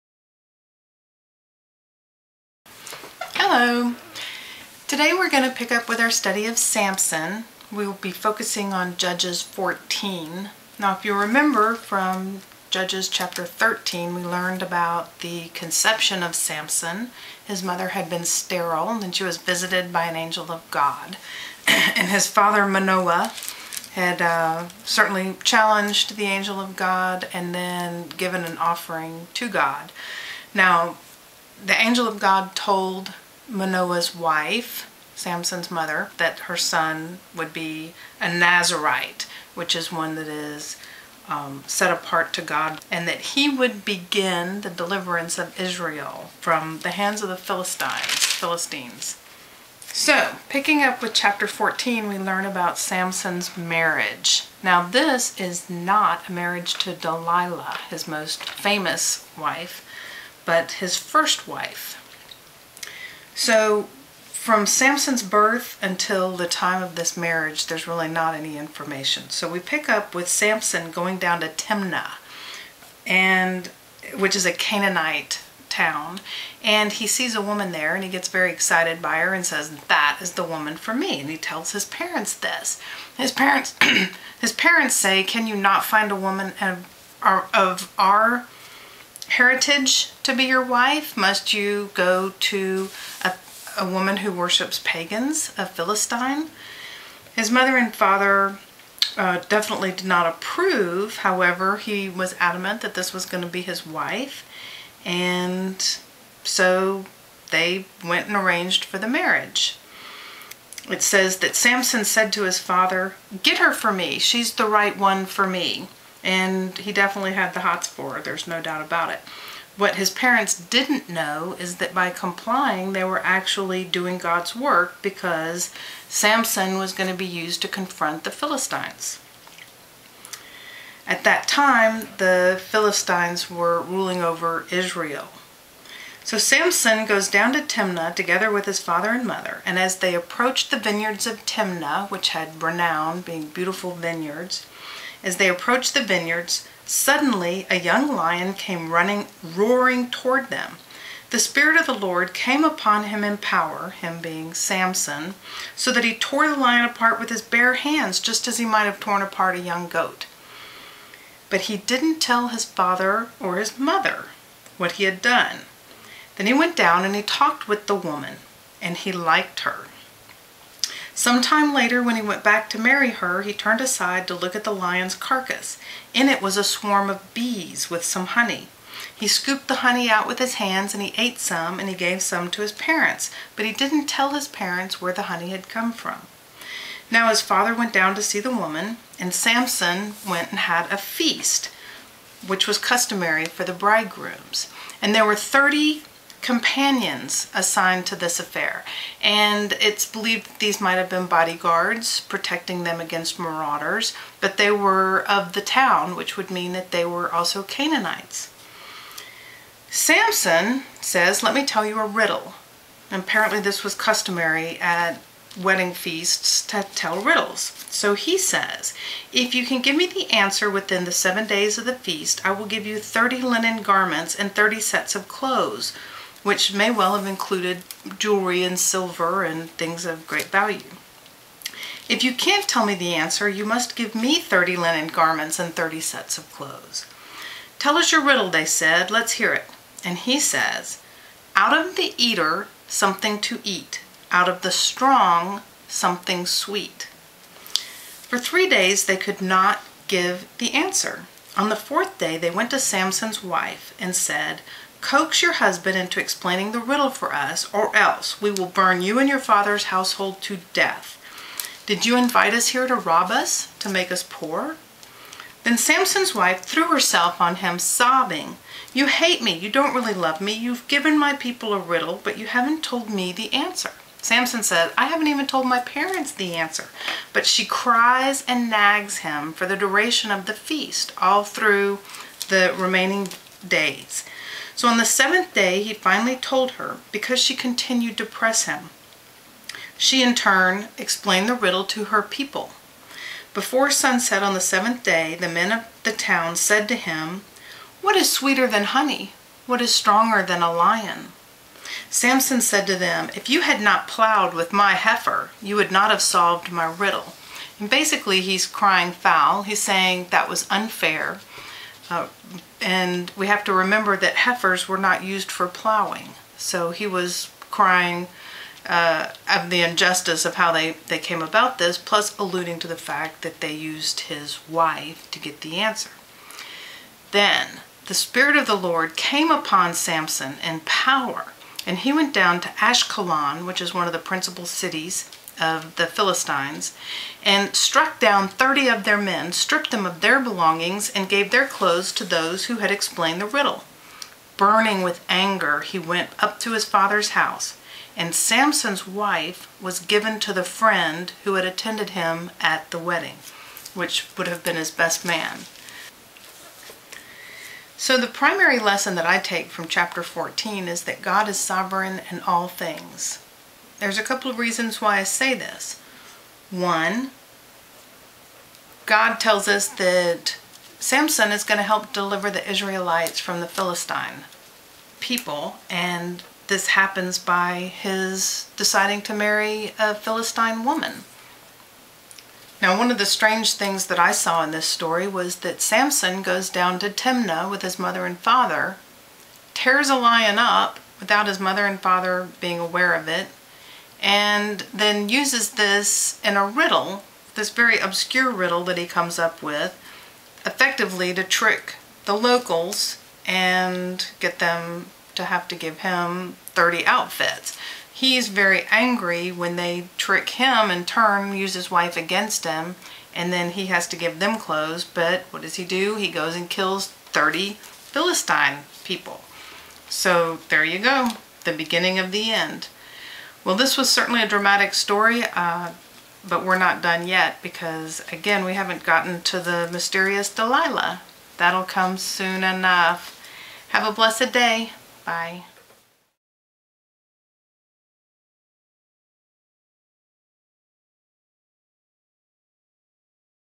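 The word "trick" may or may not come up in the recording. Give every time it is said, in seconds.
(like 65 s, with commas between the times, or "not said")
401 s, 410 s.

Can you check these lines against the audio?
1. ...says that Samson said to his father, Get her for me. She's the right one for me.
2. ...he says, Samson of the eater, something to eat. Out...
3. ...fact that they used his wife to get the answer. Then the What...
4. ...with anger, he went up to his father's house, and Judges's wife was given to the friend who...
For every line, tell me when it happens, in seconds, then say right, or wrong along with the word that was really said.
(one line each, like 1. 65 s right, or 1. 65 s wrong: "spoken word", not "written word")
1. 111 s right
2. 240 s wrong: "Out", not "Samson"
3. 322 s wrong: "Spirit", not "What"
4. 345 s wrong: "Samson", not "Judges".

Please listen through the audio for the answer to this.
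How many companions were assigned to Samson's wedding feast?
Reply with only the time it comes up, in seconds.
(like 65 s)
195 s.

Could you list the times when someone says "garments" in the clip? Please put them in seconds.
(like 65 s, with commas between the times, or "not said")
223 s, 235 s.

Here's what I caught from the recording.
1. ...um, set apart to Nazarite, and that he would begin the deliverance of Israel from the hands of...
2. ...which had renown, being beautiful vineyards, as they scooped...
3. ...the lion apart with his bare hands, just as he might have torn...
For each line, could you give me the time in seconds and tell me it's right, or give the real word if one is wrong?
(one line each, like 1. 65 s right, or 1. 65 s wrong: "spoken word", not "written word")
1. 41 s wrong: "God", not "Nazarite"
2. 142 s wrong: "approached", not "scooped"
3. 156 s right.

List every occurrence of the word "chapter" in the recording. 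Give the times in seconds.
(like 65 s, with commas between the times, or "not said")
13 s, 51 s, 359 s.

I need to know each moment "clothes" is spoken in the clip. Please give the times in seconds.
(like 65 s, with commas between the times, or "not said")
225 s, 236 s, 341 s, 414 s.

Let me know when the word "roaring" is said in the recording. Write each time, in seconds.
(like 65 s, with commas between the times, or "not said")
149 s.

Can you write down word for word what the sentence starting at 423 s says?
Well, this was certainly a dramatic story, uh, but we're not done yet because, again, we haven't gotten to the mysterious Delilah.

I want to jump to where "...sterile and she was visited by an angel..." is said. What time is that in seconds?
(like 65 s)
18 s.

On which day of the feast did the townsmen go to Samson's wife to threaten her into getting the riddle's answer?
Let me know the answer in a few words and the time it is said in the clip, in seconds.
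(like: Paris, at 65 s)
fourth day, at 251 s.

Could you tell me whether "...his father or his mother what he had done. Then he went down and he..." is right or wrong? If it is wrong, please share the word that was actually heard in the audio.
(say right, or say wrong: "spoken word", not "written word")
right.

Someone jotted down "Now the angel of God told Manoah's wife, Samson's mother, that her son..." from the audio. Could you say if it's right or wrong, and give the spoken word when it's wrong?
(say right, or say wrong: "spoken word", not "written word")
right.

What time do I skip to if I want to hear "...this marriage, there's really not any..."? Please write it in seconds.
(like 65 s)
66 s.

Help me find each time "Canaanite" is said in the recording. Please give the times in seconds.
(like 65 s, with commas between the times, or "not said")
74 s, 207 s.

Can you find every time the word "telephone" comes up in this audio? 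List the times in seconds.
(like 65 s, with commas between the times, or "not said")
not said.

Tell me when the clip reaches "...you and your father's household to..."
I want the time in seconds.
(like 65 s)
259 s.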